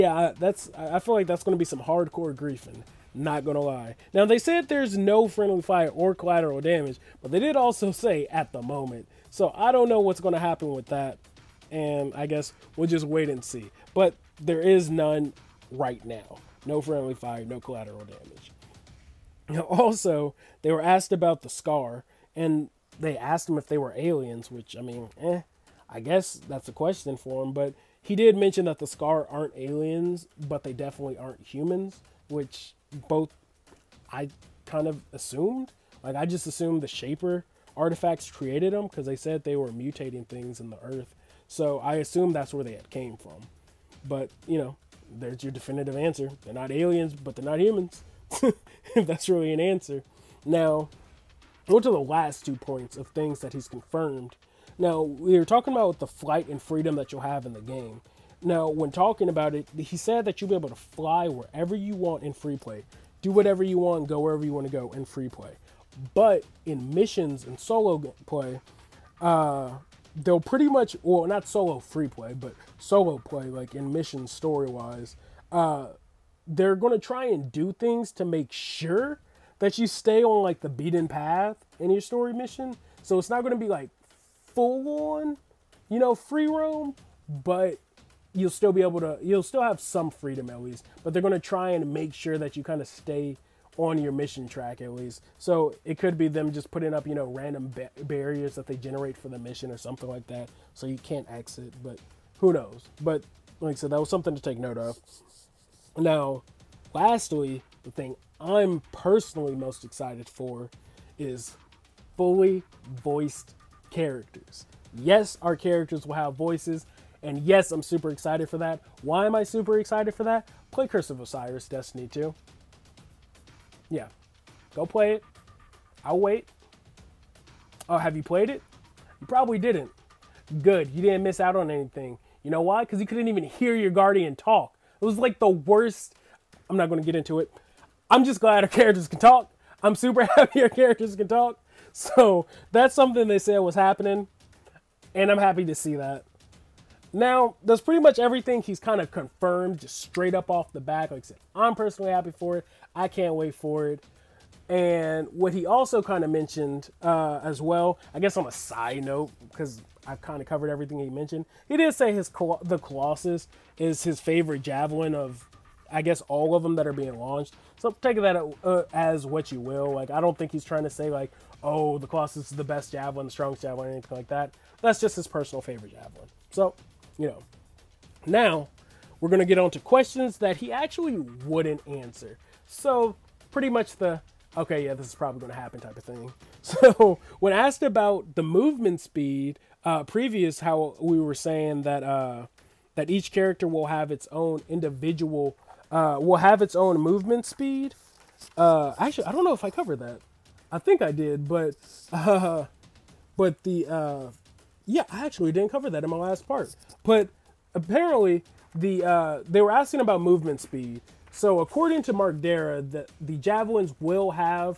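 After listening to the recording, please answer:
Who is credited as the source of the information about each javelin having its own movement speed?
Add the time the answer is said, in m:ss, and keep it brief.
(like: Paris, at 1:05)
Mark Darrah, at 3:32.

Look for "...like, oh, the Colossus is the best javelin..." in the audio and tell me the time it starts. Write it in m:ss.
2:51.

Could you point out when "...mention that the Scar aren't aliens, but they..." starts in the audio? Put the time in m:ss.
0:28.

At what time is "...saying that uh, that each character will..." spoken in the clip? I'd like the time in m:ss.
3:11.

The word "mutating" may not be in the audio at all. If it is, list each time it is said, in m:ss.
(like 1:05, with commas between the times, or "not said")
0:39.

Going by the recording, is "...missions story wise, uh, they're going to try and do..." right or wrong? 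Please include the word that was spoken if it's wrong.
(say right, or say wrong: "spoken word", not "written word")
right.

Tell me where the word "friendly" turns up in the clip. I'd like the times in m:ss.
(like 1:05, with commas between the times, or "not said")
0:05, 0:16.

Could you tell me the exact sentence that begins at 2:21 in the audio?
So that's something they said was happening.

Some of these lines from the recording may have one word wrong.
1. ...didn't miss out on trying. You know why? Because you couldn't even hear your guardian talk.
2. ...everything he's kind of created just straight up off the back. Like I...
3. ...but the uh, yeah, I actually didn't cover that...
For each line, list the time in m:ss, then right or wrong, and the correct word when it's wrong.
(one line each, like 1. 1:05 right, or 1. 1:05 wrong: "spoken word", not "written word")
1. 2:11 wrong: "anything", not "trying"
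2. 2:28 wrong: "confirmed", not "created"
3. 3:23 right.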